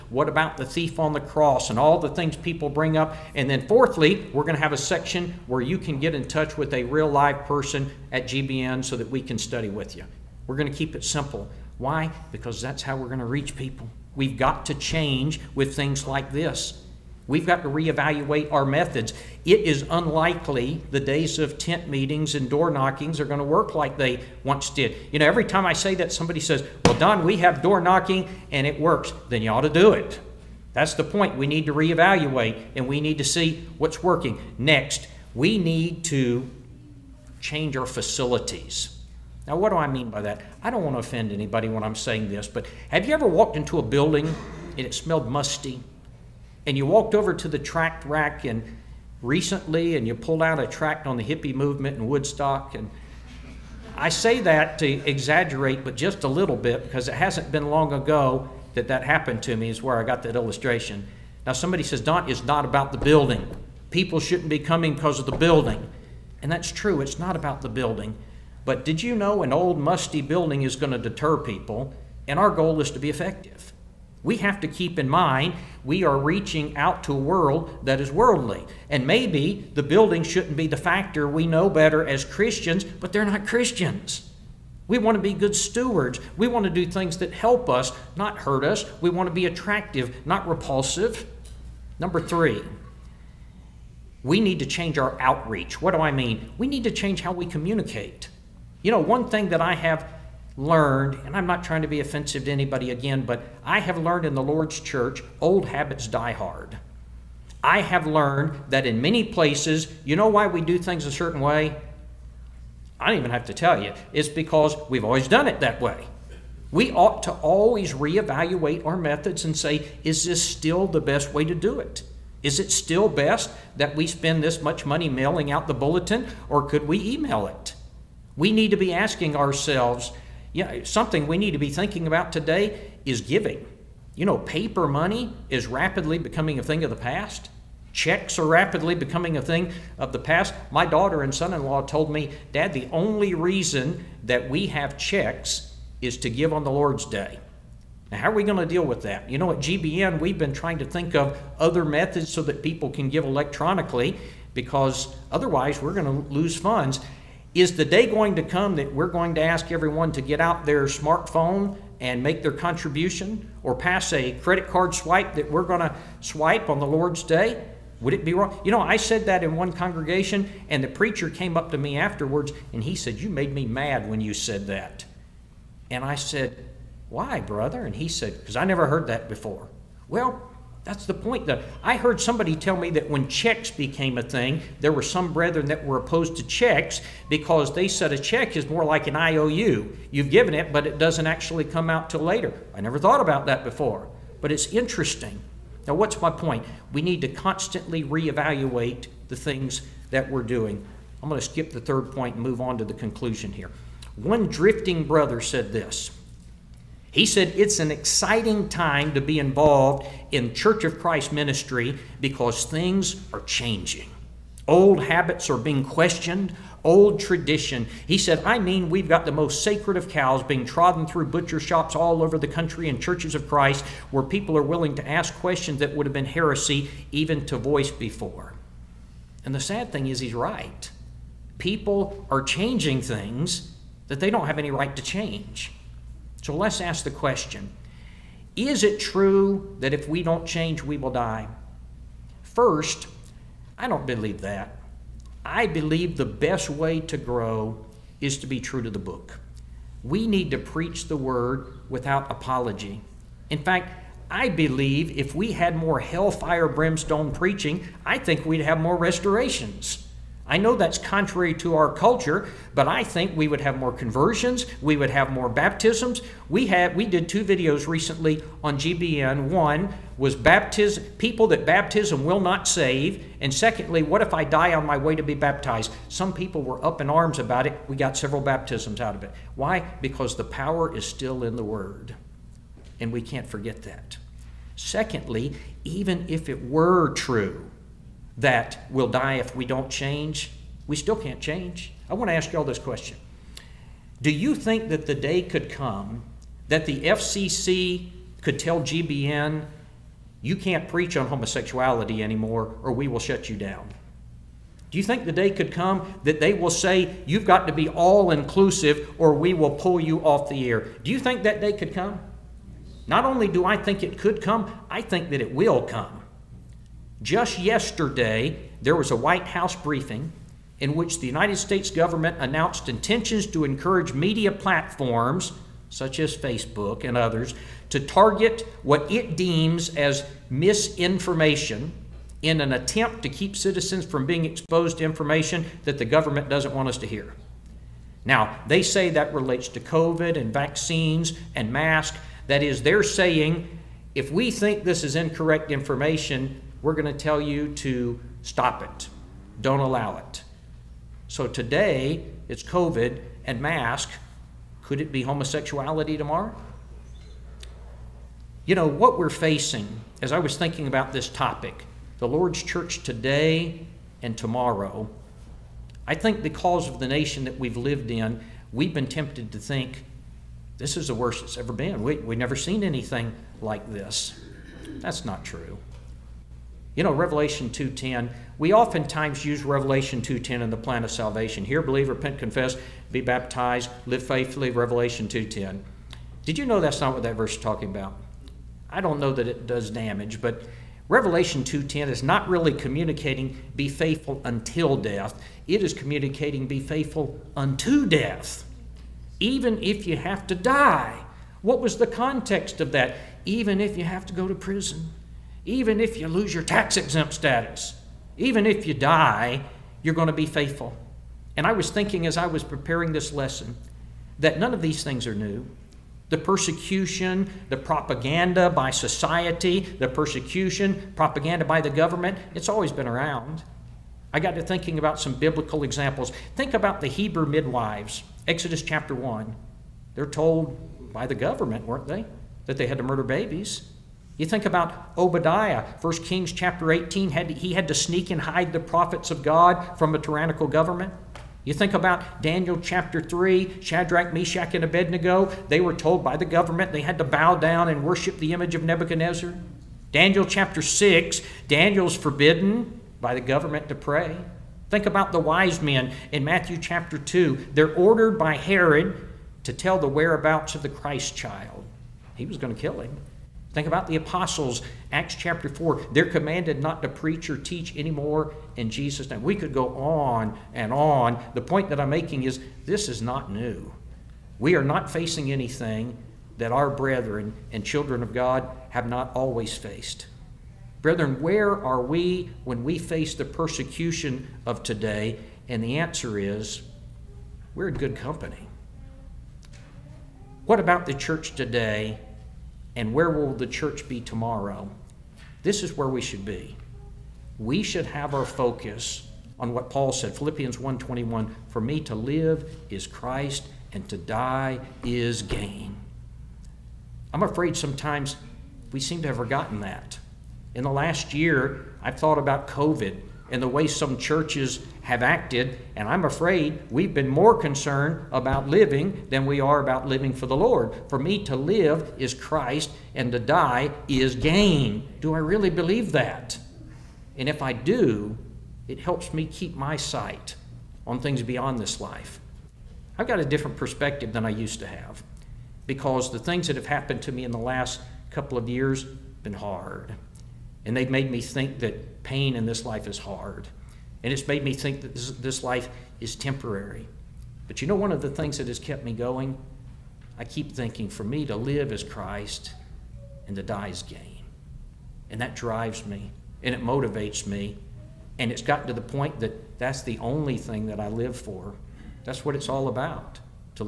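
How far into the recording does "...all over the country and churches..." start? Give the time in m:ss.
3:41.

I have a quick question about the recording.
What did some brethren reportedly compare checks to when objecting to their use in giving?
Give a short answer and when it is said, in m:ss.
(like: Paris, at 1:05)
An IOU, at 3:09.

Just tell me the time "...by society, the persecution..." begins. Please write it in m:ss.
6:58.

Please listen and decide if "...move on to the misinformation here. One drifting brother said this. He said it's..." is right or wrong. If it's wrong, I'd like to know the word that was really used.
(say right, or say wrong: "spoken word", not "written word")
wrong: "conclusion", not "misinformation".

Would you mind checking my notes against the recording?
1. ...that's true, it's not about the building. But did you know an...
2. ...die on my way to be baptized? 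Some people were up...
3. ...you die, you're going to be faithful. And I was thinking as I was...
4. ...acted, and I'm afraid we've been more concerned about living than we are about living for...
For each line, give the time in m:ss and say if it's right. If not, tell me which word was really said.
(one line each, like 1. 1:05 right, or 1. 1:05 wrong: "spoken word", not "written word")
1. 1:06 right
2. 4:34 right
3. 6:48 right
4. 8:35 right.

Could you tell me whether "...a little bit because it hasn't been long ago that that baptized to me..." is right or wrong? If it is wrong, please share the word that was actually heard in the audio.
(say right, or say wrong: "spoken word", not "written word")
wrong: "happened", not "baptized".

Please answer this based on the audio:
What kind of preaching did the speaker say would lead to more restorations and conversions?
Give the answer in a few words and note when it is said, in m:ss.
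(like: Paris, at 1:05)
Hellfire brimstone preaching, at 4:16.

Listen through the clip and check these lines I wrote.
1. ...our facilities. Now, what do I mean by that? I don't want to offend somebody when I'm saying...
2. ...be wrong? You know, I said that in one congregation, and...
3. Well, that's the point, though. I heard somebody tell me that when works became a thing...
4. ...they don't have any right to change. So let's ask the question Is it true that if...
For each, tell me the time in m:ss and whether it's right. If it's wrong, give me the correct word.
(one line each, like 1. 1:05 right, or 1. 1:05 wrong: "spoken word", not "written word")
1. 0:37 wrong: "anybody", not "somebody"
2. 2:48 right
3. 3:00 wrong: "checks", not "works"
4. 3:54 right.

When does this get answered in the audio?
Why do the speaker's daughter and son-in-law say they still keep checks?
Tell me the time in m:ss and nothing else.
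2:26.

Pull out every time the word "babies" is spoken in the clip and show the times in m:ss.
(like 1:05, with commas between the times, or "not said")
7:13.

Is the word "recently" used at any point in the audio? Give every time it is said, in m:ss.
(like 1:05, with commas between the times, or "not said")
0:49, 4:27.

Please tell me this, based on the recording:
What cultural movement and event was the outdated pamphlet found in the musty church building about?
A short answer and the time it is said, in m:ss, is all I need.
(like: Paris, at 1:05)
The hippie movement in Woodstock, at 0:51.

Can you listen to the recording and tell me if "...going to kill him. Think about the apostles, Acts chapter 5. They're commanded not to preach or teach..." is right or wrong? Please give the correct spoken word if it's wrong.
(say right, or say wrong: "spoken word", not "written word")
wrong: "4", not "5".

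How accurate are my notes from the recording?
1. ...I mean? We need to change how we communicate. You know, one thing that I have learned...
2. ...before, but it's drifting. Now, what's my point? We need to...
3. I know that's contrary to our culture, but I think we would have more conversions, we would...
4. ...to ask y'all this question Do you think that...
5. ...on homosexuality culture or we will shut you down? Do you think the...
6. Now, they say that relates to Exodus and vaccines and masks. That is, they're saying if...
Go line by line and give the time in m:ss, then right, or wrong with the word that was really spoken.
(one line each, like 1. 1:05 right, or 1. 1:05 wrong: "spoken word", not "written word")
1. 1:35 right
2. 3:13 wrong: "interesting", not "drifting"
3. 4:20 right
4. 4:52 right
5. 5:01 wrong: "anymore", not "culture"
6. 5:38 wrong: "COVID", not "Exodus".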